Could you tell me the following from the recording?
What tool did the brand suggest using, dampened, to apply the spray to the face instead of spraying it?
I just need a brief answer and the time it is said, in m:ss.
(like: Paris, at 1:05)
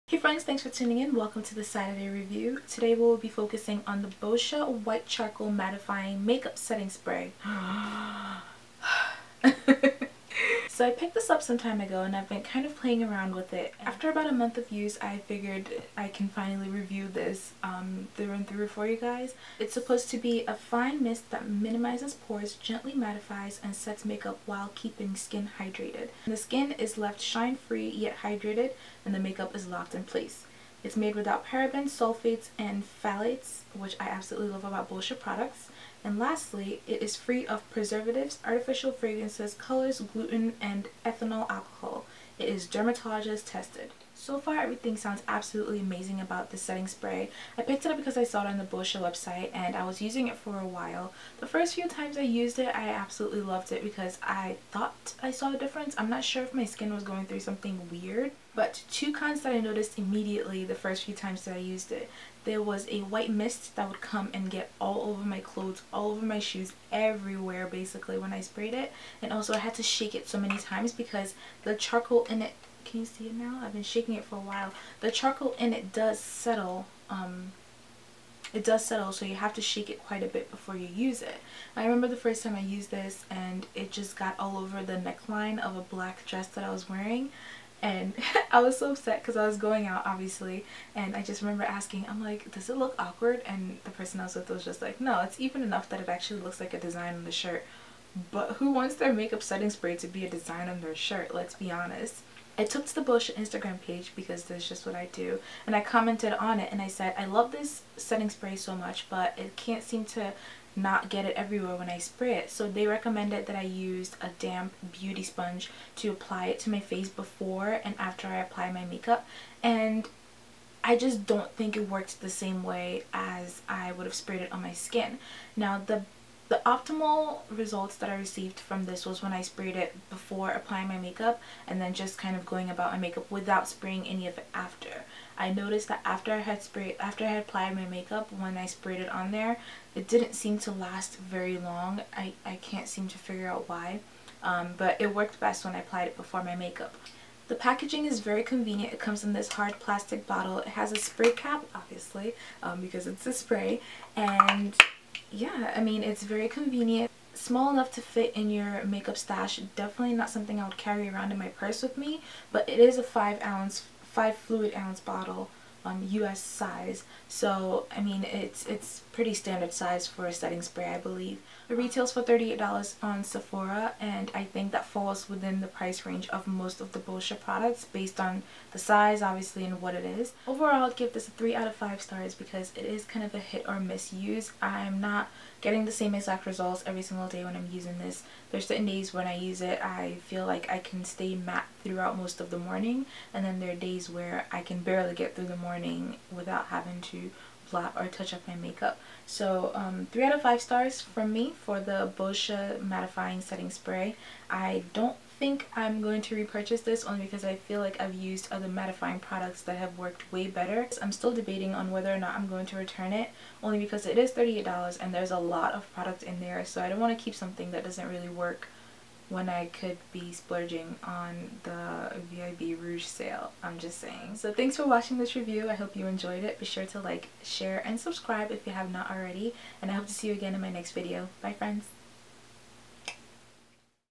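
beauty sponge, at 1:54.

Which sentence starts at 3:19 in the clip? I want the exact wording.
So um, 3 out of 5 stars from me for the Boscia Mattifying Setting Spray.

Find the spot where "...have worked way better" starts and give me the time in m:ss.
3:29.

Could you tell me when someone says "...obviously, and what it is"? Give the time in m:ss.
2:59.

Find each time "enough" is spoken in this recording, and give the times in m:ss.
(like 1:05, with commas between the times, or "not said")
1:35, 2:37.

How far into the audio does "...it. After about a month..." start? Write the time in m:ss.
0:13.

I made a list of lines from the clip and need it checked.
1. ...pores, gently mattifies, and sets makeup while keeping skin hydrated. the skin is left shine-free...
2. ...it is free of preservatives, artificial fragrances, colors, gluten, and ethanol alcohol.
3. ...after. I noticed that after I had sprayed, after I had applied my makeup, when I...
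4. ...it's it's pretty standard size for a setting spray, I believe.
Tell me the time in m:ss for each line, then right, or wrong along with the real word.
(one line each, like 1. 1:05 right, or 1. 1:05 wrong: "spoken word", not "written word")
1. 0:22 right
2. 0:36 right
3. 2:14 right
4. 2:48 right.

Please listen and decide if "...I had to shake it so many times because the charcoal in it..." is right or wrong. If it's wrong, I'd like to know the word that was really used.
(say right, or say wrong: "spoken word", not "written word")
right.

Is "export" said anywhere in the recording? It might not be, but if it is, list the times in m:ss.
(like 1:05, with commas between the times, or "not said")
not said.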